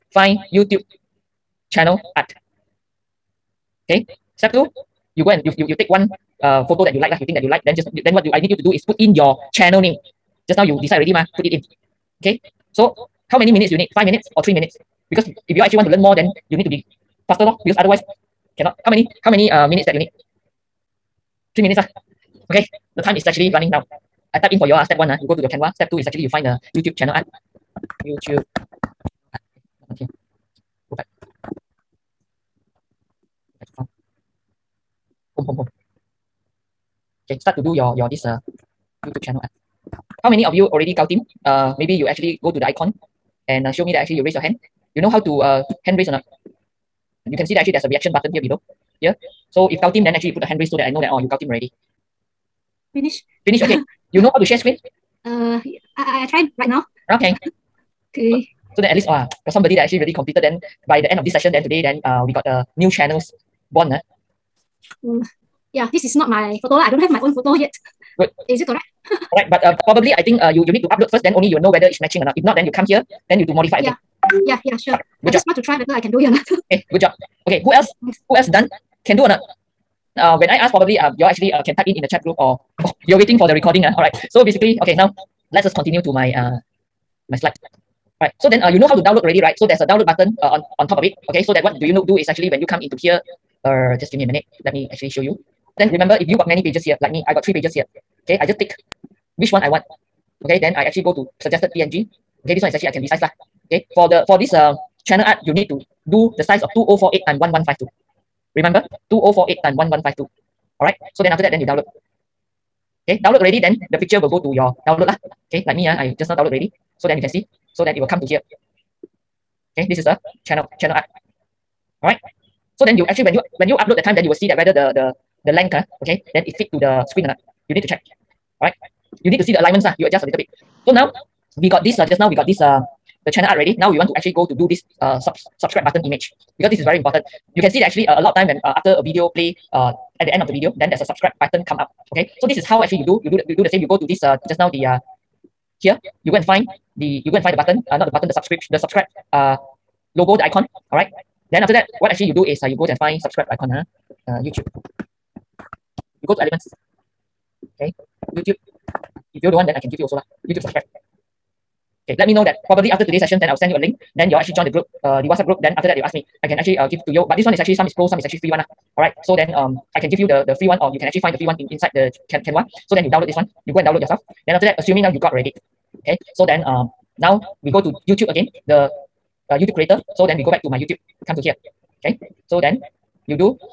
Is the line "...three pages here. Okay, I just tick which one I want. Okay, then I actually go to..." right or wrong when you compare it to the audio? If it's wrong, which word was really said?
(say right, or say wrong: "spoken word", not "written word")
right.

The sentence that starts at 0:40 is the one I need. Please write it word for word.
How many of you already got team?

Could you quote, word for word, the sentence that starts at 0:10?
Just now you decide already ma, put it in.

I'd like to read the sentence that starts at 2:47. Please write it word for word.
But this one is actually, some is pro, some is actually free one.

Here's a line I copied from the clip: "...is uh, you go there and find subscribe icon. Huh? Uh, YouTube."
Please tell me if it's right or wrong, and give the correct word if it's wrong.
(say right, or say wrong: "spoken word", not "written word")
right.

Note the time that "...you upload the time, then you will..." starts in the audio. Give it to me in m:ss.
2:03.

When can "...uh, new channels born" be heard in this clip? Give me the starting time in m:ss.
1:02.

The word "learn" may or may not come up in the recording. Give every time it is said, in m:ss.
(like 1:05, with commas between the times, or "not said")
0:15.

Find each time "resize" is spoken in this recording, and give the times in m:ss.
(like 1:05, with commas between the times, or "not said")
1:42.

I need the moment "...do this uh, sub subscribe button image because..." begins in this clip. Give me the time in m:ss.
2:14.